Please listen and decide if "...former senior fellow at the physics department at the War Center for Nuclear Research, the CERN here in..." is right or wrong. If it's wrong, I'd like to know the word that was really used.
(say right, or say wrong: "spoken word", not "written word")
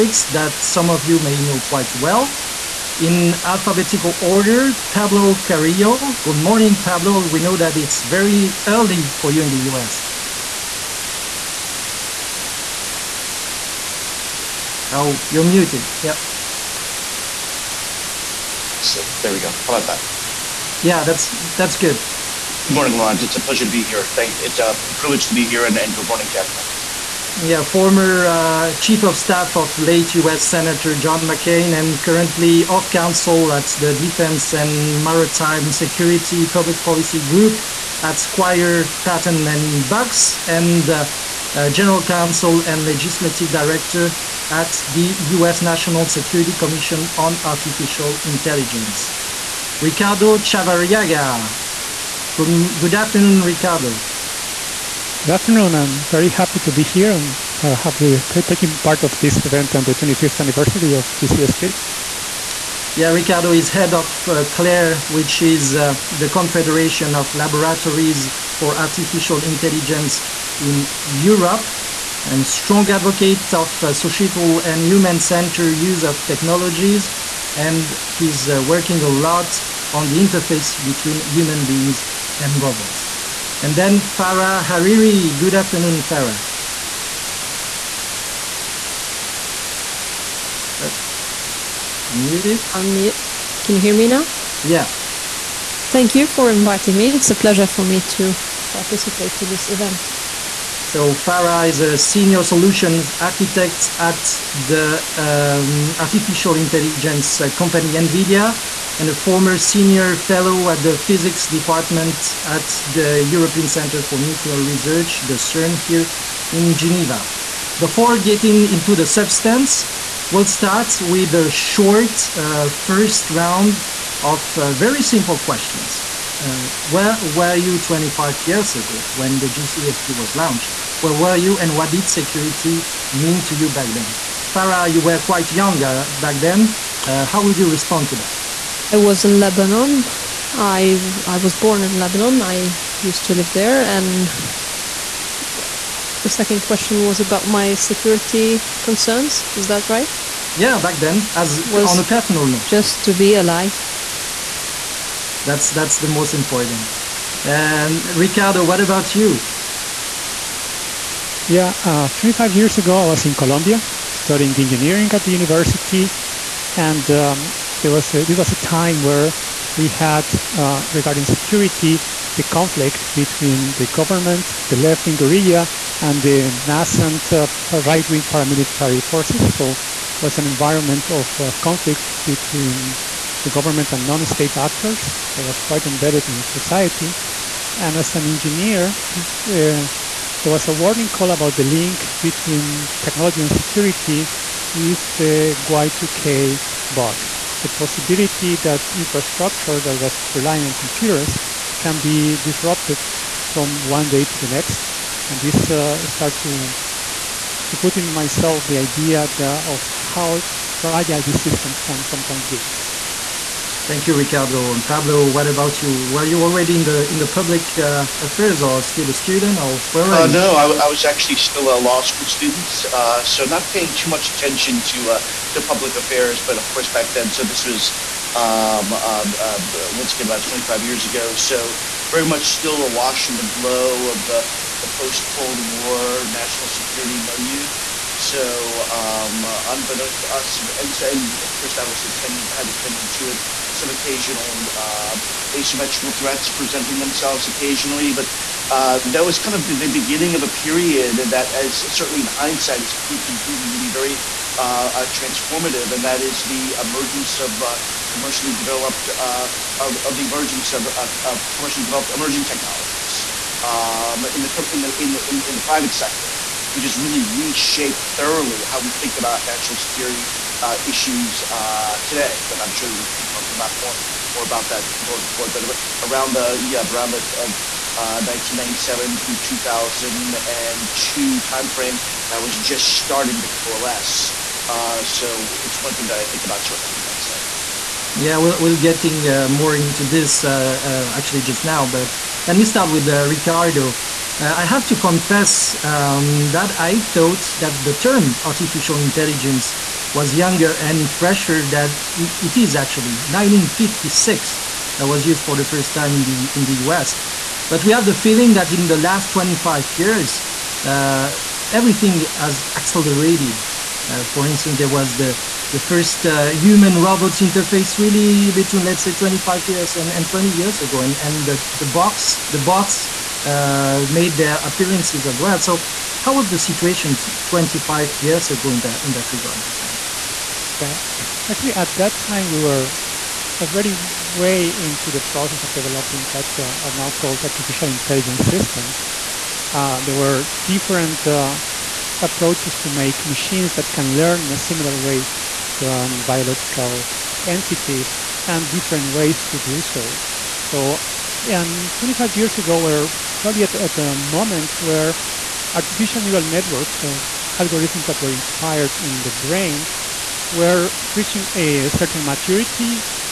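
wrong: "European", not "War".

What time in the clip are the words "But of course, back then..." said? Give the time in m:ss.
3:46.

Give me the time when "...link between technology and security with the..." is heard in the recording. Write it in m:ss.
3:11.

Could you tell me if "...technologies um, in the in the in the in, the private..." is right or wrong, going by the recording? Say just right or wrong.
right.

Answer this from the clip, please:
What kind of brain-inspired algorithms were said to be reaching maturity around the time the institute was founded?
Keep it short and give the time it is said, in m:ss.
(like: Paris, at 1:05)
artificial neural networks, at 5:55.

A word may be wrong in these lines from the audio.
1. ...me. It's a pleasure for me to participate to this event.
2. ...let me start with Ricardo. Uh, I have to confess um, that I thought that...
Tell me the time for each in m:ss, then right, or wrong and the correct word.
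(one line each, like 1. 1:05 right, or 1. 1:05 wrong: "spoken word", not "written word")
1. 1:36 right
2. 4:52 right.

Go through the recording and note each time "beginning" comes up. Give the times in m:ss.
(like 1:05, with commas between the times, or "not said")
4:09.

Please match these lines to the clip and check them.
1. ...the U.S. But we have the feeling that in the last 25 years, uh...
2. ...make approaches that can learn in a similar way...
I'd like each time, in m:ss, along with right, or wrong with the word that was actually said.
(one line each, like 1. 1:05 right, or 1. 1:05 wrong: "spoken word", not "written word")
1. 5:06 right
2. 5:42 wrong: "machines", not "approaches".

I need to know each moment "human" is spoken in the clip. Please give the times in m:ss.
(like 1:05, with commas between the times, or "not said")
1:14, 1:21, 5:16.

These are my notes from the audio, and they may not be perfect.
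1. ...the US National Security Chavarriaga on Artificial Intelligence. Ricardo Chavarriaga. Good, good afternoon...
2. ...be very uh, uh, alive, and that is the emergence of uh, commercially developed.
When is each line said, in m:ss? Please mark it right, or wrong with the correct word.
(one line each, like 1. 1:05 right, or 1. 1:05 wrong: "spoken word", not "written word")
1. 0:44 wrong: "Commission", not "Chavarriaga"
2. 4:13 wrong: "transformative", not "alive".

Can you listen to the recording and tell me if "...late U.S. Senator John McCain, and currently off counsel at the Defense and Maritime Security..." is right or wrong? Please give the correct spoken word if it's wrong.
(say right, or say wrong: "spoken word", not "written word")
right.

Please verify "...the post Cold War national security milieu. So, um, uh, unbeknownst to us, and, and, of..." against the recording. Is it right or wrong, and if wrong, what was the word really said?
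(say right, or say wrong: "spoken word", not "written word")
right.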